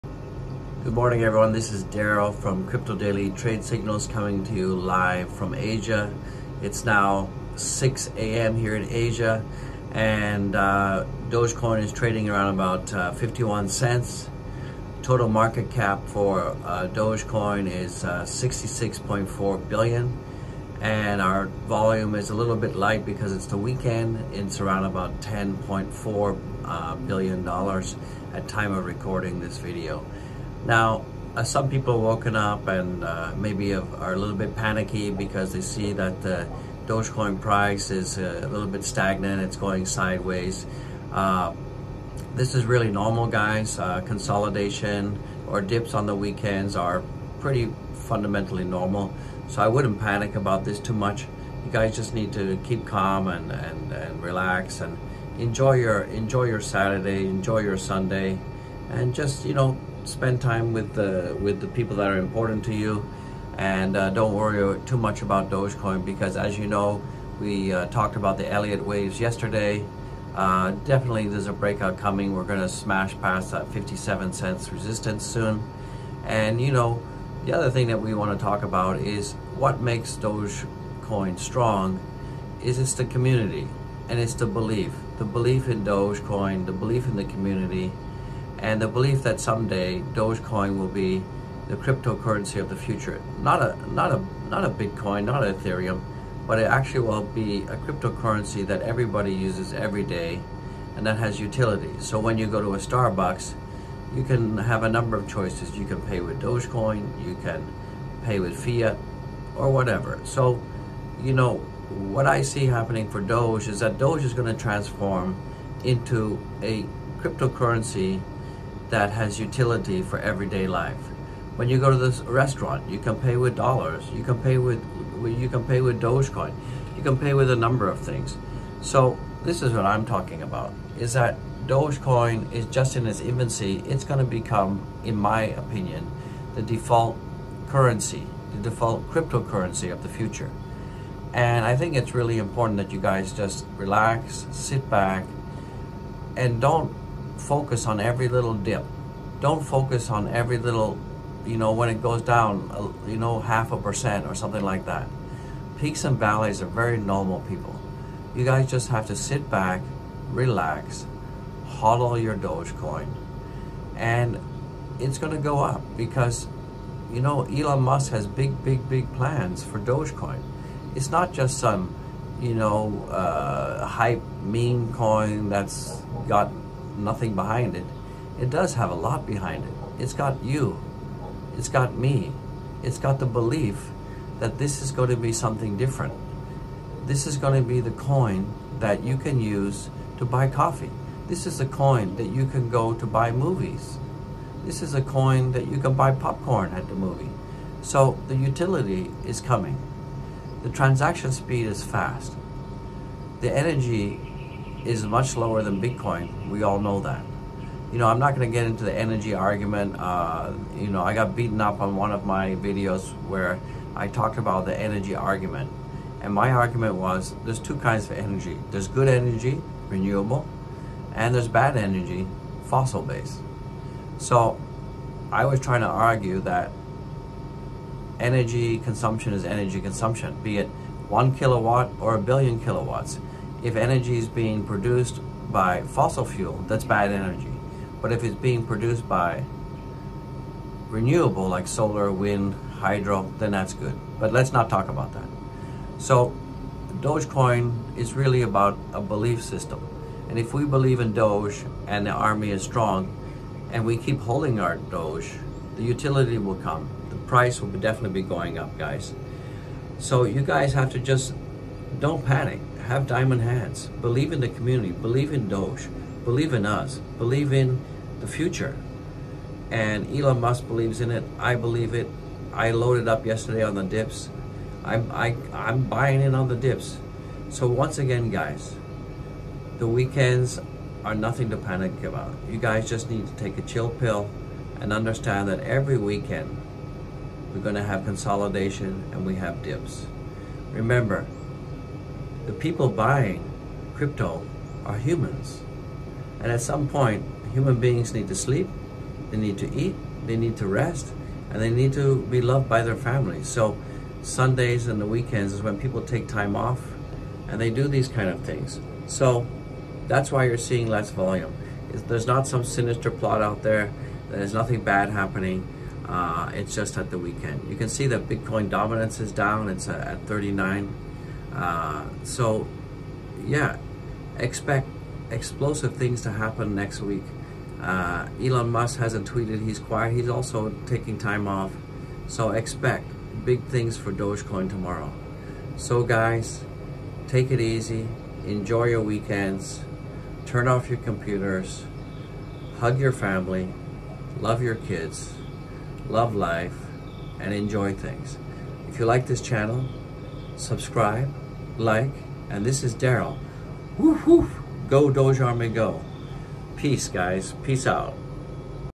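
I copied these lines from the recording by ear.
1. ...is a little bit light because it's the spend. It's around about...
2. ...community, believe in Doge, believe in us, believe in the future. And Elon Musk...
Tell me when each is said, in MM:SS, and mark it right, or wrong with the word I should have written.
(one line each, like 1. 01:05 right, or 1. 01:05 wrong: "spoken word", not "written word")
1. 00:22 wrong: "weekend", not "spend"
2. 04:24 right.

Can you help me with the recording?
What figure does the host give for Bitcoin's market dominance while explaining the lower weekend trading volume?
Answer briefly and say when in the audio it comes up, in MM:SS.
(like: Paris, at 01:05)
39, at 05:20.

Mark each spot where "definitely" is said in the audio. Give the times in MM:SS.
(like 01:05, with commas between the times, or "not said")
01:10, 04:17.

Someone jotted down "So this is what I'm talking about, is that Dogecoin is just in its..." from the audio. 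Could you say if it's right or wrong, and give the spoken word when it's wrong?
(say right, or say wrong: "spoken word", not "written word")
right.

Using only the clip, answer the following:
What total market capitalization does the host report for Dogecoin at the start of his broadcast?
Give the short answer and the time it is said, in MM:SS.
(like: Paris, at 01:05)
$66.4 billion, at 00:18.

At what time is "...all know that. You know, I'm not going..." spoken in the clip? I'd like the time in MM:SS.
03:26.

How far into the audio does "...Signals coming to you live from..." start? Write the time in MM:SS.
00:03.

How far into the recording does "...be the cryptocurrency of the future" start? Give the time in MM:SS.
01:30.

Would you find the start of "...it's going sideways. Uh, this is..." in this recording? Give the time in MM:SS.
00:39.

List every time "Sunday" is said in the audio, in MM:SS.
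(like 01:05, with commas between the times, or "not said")
00:57, 05:04.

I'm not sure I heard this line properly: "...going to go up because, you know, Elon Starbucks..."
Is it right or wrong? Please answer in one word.
wrong.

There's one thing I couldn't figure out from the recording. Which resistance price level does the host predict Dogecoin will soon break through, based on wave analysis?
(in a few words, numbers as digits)
57 cents.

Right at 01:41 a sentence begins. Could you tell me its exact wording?
So when you go to a Starbucks, you can have a number of choices.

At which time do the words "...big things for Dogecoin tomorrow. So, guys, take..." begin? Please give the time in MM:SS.
05:33.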